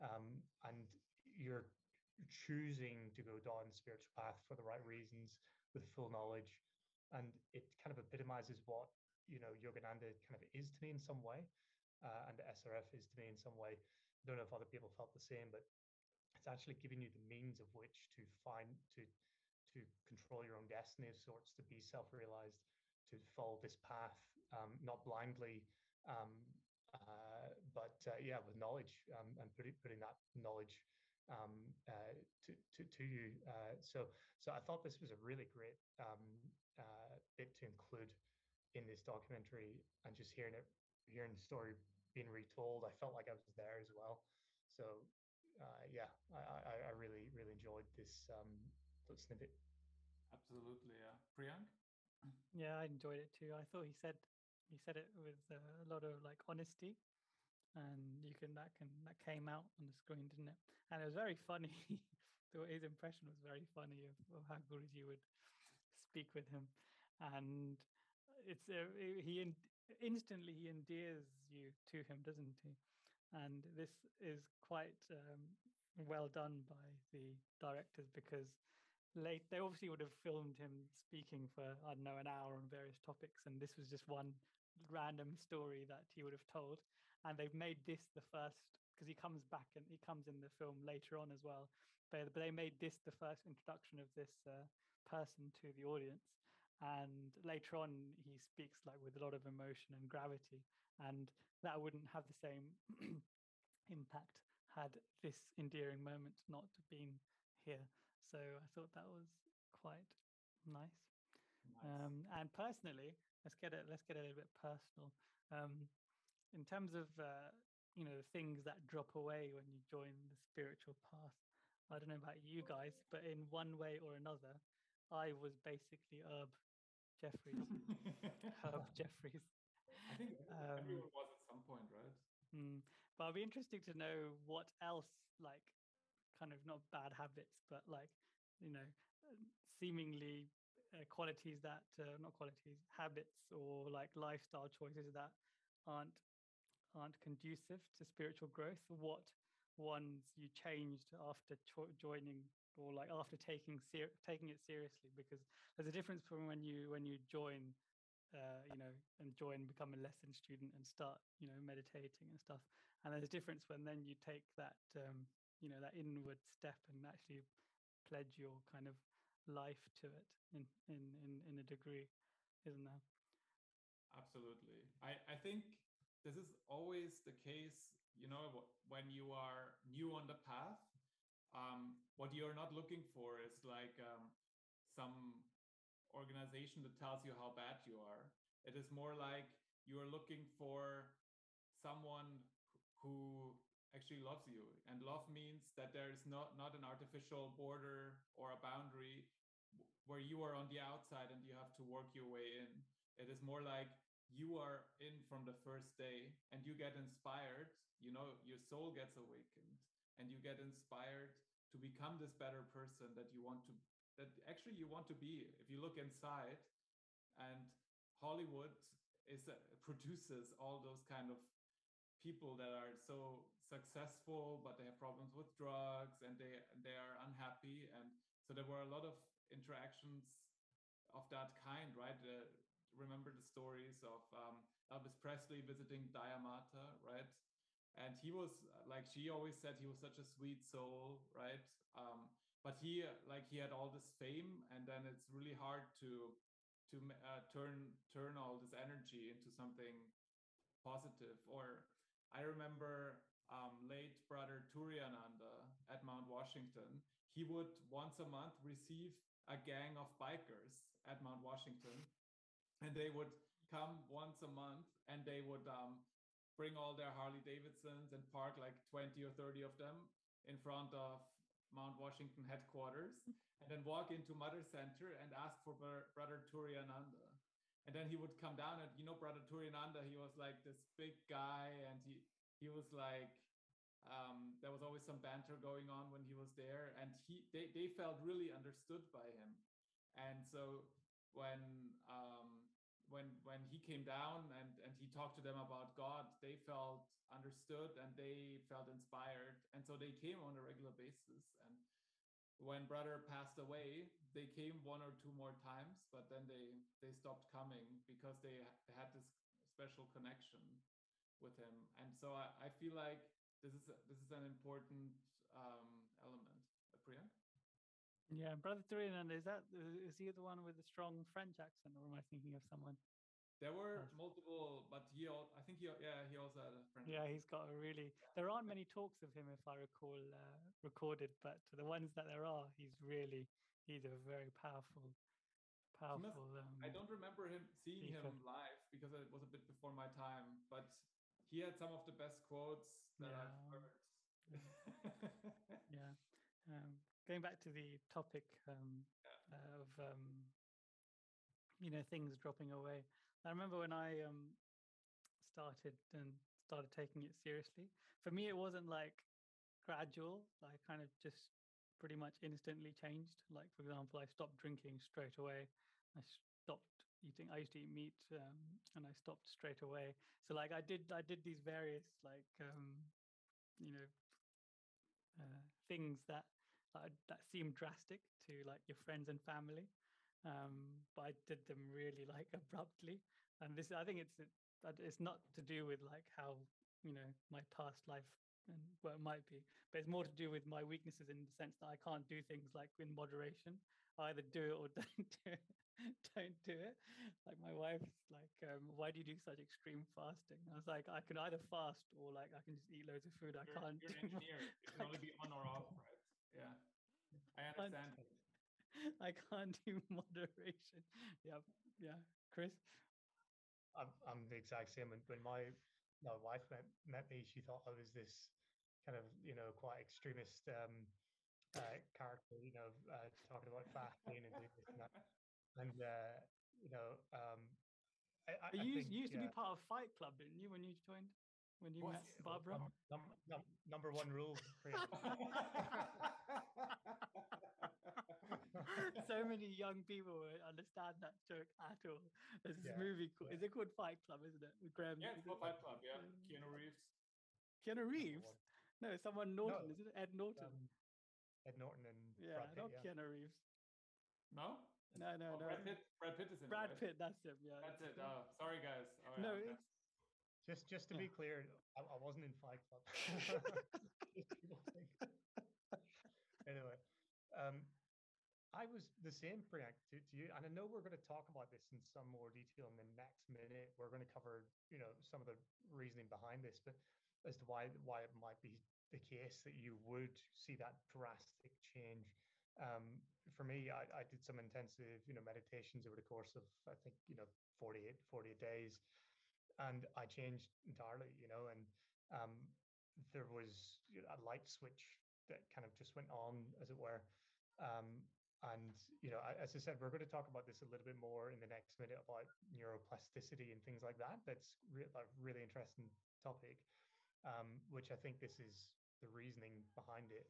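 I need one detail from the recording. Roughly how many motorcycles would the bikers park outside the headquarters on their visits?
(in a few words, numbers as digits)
20 or 30.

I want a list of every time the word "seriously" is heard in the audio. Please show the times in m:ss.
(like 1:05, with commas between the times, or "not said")
2:34, 5:57.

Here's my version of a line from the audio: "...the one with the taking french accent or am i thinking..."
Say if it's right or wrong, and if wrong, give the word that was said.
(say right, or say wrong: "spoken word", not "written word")
wrong: "strong", not "taking".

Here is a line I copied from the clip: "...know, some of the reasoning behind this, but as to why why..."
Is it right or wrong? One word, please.
right.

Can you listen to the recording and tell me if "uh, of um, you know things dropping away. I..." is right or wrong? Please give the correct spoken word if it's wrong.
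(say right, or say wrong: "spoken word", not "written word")
right.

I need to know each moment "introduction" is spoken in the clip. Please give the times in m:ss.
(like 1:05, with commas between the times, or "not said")
1:33.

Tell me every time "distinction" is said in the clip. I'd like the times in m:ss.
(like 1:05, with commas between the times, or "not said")
not said.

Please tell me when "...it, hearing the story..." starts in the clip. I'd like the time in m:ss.
0:40.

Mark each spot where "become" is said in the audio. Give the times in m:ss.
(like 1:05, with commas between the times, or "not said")
2:39, 3:31.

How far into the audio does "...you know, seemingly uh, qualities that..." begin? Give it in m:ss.
2:18.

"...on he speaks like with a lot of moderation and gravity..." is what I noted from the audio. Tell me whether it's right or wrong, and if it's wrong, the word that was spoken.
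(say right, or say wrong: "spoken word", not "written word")
wrong: "emotion", not "moderation".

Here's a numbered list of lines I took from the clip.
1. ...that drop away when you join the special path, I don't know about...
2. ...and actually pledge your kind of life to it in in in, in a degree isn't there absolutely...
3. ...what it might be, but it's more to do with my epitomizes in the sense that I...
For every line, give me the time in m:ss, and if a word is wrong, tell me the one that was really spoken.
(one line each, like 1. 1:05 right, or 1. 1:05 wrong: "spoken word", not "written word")
1. 1:58 wrong: "spiritual", not "special"
2. 2:46 right
3. 6:29 wrong: "weaknesses", not "epitomizes".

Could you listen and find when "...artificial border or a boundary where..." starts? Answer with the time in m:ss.
3:16.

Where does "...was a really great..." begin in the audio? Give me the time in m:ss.
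0:34.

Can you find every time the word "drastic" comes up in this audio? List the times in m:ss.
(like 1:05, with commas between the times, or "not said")
6:17, 8:01.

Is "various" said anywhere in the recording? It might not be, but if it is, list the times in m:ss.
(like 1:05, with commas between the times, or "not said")
1:22, 6:11.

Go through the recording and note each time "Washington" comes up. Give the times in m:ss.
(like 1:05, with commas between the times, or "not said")
4:16, 4:21, 4:31.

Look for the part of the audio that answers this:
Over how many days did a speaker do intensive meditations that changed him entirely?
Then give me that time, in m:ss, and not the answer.
8:08.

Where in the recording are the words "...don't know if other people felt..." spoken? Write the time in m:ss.
0:14.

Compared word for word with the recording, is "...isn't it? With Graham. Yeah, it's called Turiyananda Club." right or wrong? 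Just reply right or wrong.
wrong.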